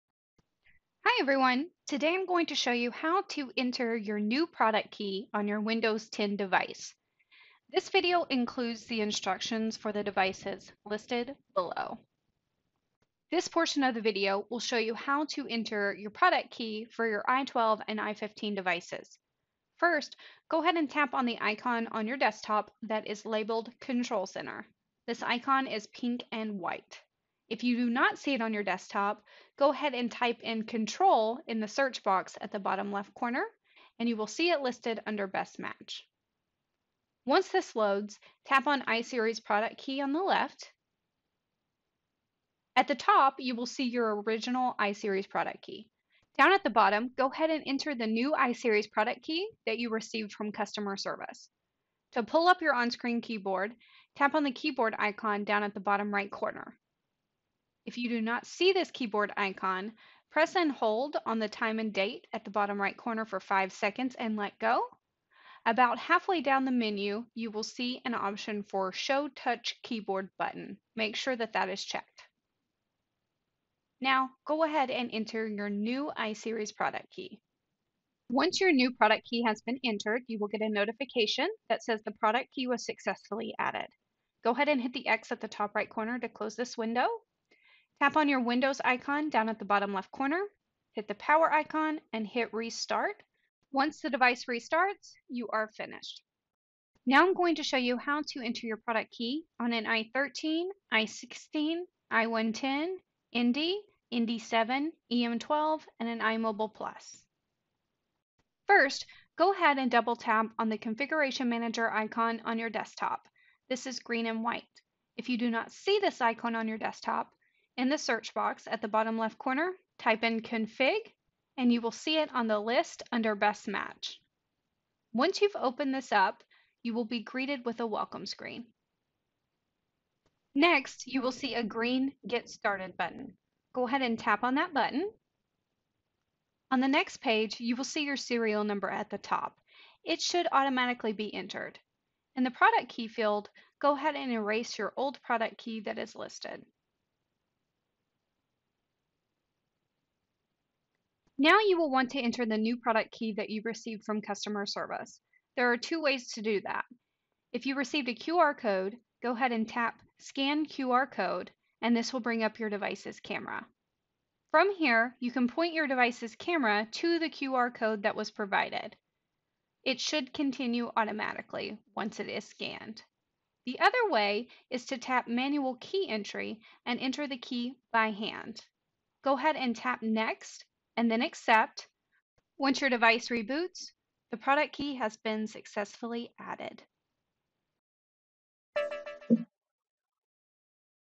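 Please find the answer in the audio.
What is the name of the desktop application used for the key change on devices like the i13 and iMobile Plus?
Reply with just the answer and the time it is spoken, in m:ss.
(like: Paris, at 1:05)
Configuration Manager, at 1:50.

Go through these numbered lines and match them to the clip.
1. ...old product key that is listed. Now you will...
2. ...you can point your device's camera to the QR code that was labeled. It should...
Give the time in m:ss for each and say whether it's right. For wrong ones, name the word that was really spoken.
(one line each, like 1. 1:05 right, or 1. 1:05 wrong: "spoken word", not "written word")
1. 2:24 right
2. 2:45 wrong: "provided", not "labeled".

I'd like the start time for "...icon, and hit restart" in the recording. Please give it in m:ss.
1:31.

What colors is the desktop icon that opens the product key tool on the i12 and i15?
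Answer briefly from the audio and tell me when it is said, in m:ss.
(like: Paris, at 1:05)
Pink and white, at 0:25.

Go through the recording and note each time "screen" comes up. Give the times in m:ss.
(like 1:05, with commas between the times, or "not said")
0:52, 2:08.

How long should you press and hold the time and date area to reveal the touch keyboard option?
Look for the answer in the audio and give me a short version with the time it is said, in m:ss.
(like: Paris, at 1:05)
5 seconds, at 1:03.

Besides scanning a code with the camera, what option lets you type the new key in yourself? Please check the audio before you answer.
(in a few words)
Manual Key Entry.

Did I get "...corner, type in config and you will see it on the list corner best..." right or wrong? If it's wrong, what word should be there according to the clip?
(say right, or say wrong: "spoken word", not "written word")
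wrong: "under", not "corner".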